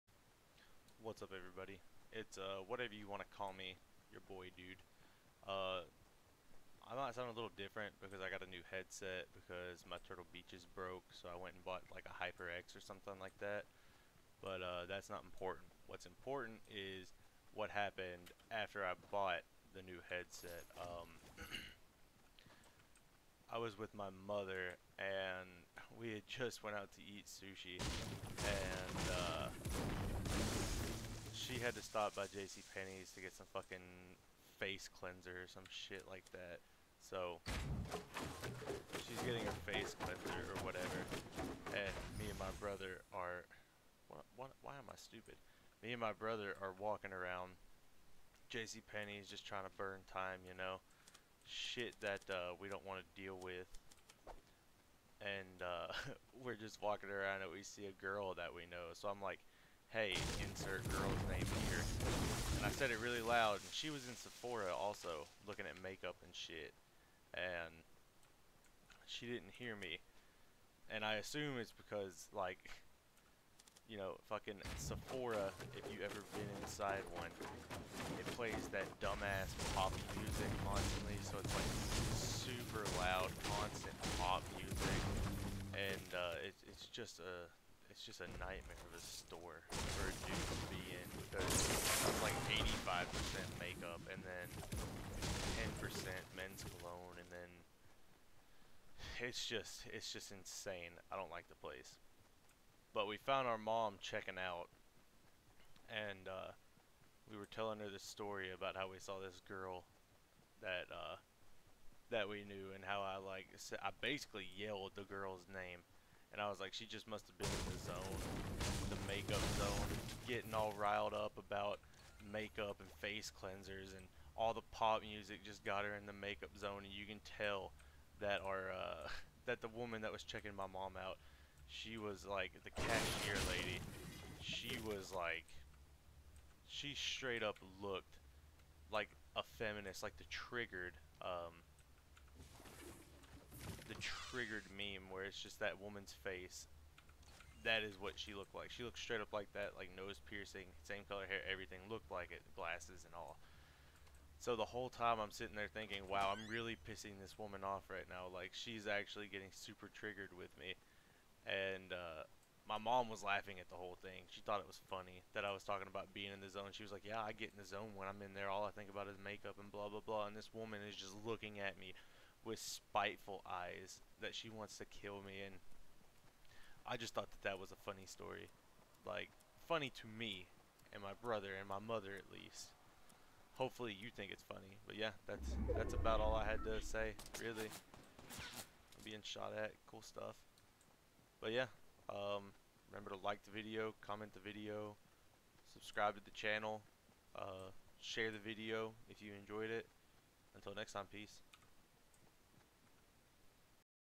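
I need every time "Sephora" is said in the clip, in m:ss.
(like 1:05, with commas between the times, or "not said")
1:04, 1:14.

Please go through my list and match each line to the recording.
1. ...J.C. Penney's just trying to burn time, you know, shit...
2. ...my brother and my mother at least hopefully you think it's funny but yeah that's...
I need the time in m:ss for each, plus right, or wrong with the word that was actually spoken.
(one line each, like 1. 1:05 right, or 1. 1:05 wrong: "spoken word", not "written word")
1. 0:48 right
2. 3:01 right.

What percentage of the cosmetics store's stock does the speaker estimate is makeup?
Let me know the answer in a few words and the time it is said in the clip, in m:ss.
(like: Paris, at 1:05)
85%, at 1:32.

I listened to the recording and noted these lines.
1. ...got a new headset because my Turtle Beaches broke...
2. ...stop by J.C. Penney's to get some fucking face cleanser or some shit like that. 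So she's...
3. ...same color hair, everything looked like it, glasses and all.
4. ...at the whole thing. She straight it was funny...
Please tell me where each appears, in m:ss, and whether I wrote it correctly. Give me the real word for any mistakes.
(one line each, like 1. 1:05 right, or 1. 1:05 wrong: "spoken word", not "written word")
1. 0:08 right
2. 0:31 right
3. 2:30 right
4. 2:43 wrong: "thought", not "straight".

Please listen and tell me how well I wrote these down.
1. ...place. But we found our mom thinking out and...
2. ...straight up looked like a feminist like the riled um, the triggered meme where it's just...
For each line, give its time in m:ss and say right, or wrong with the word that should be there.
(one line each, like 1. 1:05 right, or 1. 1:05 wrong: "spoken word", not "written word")
1. 1:41 wrong: "checking", not "thinking"
2. 2:16 wrong: "triggered", not "riled".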